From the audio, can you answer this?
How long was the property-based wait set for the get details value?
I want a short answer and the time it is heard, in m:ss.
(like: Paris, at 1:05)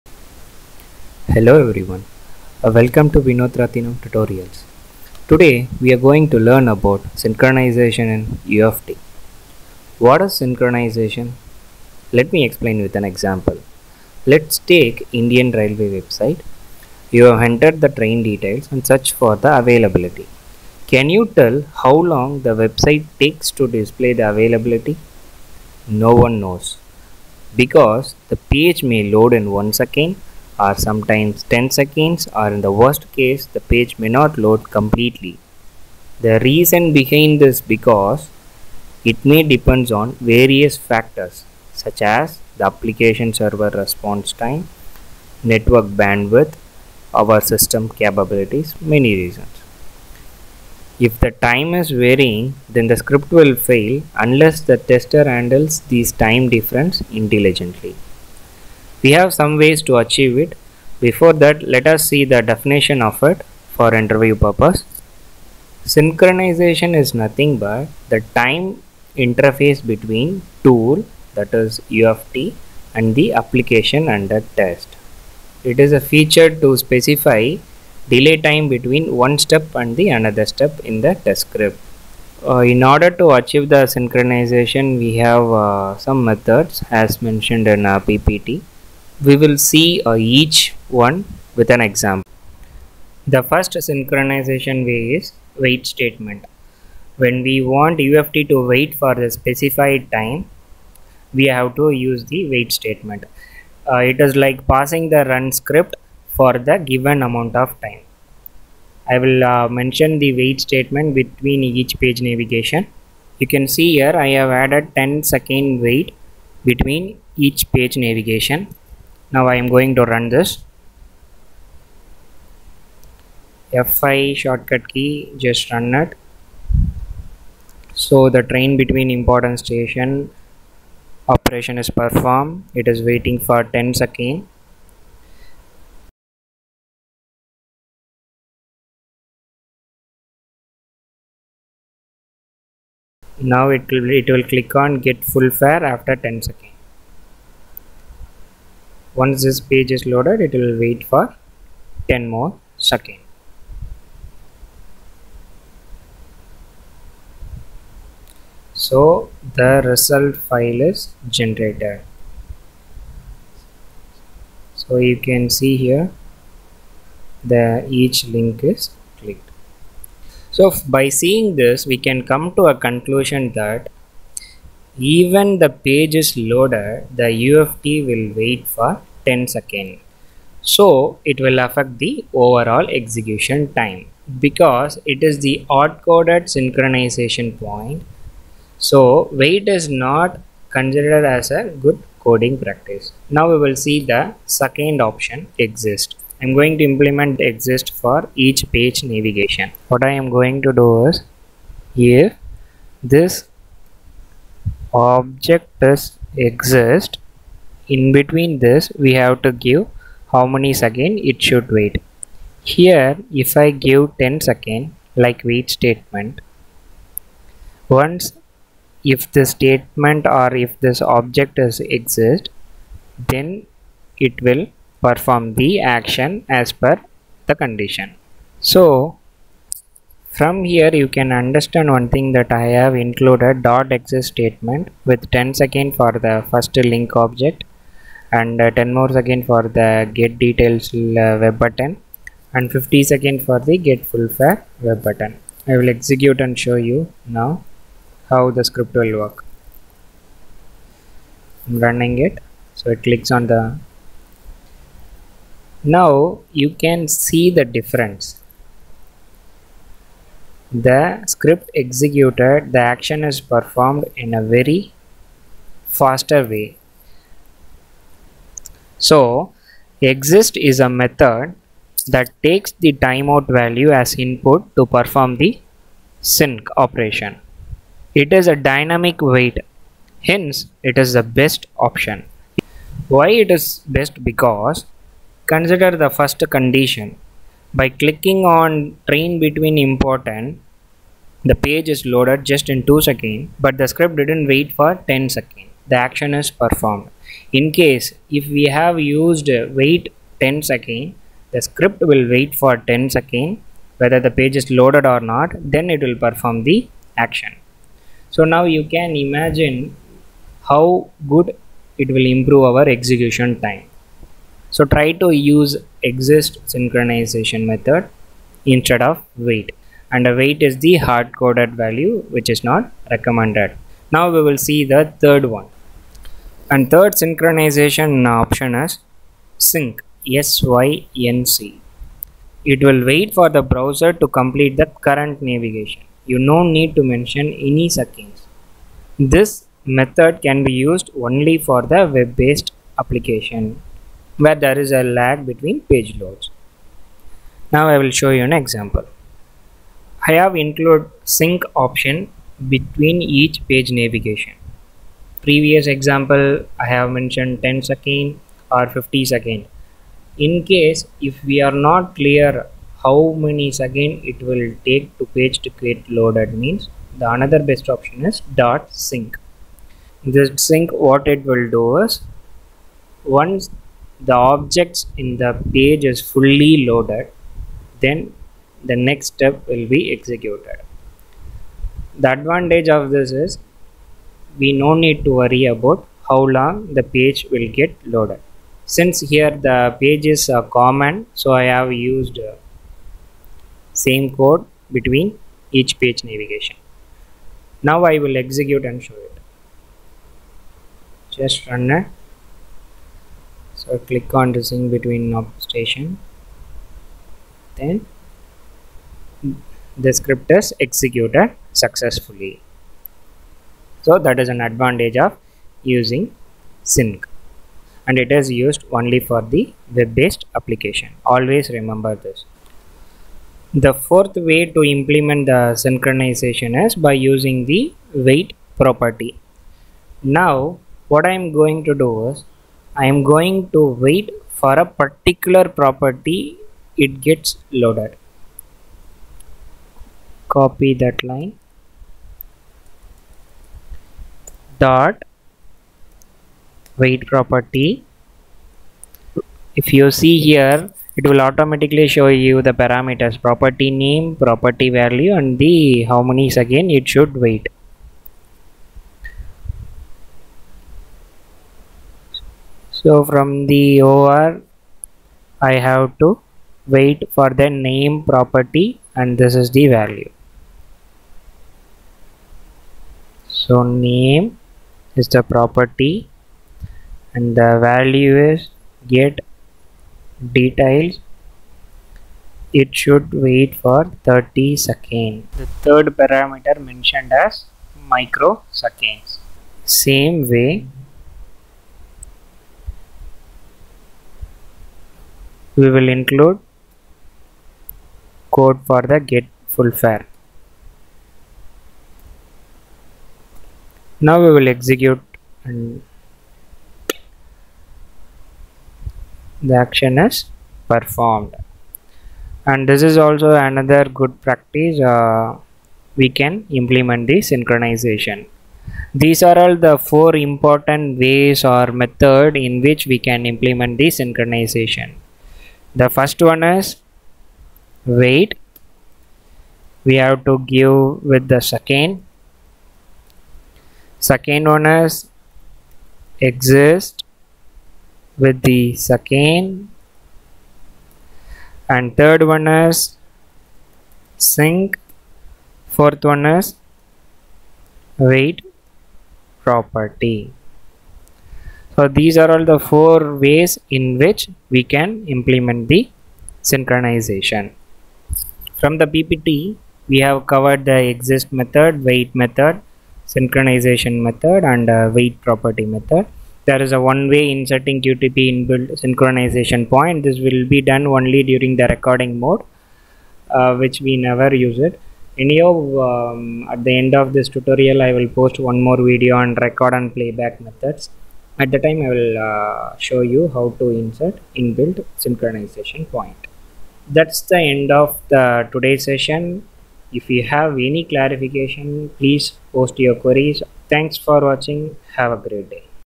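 30 seconds, at 8:04.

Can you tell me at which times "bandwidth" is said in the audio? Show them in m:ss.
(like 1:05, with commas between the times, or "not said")
0:46.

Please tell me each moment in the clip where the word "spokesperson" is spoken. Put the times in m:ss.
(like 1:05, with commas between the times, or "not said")
not said.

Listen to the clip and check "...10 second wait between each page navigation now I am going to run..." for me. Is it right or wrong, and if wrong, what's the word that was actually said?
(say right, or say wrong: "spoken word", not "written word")
right.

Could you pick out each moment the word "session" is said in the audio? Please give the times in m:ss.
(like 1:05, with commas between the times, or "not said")
9:49.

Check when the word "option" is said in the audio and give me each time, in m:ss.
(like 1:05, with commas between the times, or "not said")
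3:15, 4:41, 5:28, 5:51, 6:07.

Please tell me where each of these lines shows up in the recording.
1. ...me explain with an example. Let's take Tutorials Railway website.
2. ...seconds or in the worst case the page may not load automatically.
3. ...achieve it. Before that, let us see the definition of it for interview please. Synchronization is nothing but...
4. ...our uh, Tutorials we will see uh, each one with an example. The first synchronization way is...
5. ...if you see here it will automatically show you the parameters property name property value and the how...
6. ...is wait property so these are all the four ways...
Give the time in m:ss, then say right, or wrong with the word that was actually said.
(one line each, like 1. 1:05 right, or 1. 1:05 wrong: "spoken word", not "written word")
1. 0:12 wrong: "Indian", not "Tutorials"
2. 0:31 wrong: "completely", not "automatically"
3. 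0:59 wrong: "purpose", not "please"
4. 1:27 wrong: "PPT", not "Tutorials"
5. 7:29 right
6. 9:06 right.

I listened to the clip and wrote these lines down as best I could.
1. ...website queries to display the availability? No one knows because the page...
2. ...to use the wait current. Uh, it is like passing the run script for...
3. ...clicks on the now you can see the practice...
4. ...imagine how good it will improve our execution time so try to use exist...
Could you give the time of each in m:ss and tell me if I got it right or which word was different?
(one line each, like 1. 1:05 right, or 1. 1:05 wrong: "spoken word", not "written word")
1. 0:22 wrong: "takes", not "queries"
2. 1:41 wrong: "statement", not "current"
3. 4:13 wrong: "difference", not "practice"
4. 5:09 right.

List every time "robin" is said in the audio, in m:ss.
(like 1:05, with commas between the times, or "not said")
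not said.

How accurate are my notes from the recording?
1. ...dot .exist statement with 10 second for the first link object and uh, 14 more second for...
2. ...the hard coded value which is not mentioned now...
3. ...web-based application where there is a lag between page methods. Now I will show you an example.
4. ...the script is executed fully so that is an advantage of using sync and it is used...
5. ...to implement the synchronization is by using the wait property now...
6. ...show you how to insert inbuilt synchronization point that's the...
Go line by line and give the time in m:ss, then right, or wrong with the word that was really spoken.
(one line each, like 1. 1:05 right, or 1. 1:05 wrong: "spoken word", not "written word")
1. 3:53 wrong: "10", not "14"
2. 5:20 wrong: "recommended", not "mentioned"
3. 5:42 wrong: "loads", not "methods"
4. 6:50 wrong: "successfully", not "fully"
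5. 7:04 right
6. 9:42 right.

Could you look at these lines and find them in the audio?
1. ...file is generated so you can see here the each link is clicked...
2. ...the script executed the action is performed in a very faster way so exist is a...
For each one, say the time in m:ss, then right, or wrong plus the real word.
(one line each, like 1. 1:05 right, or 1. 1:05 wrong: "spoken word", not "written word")
1. 2:40 right
2. 4:20 right.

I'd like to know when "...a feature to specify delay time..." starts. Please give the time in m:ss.
1:15.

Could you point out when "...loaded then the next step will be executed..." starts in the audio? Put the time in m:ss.
6:16.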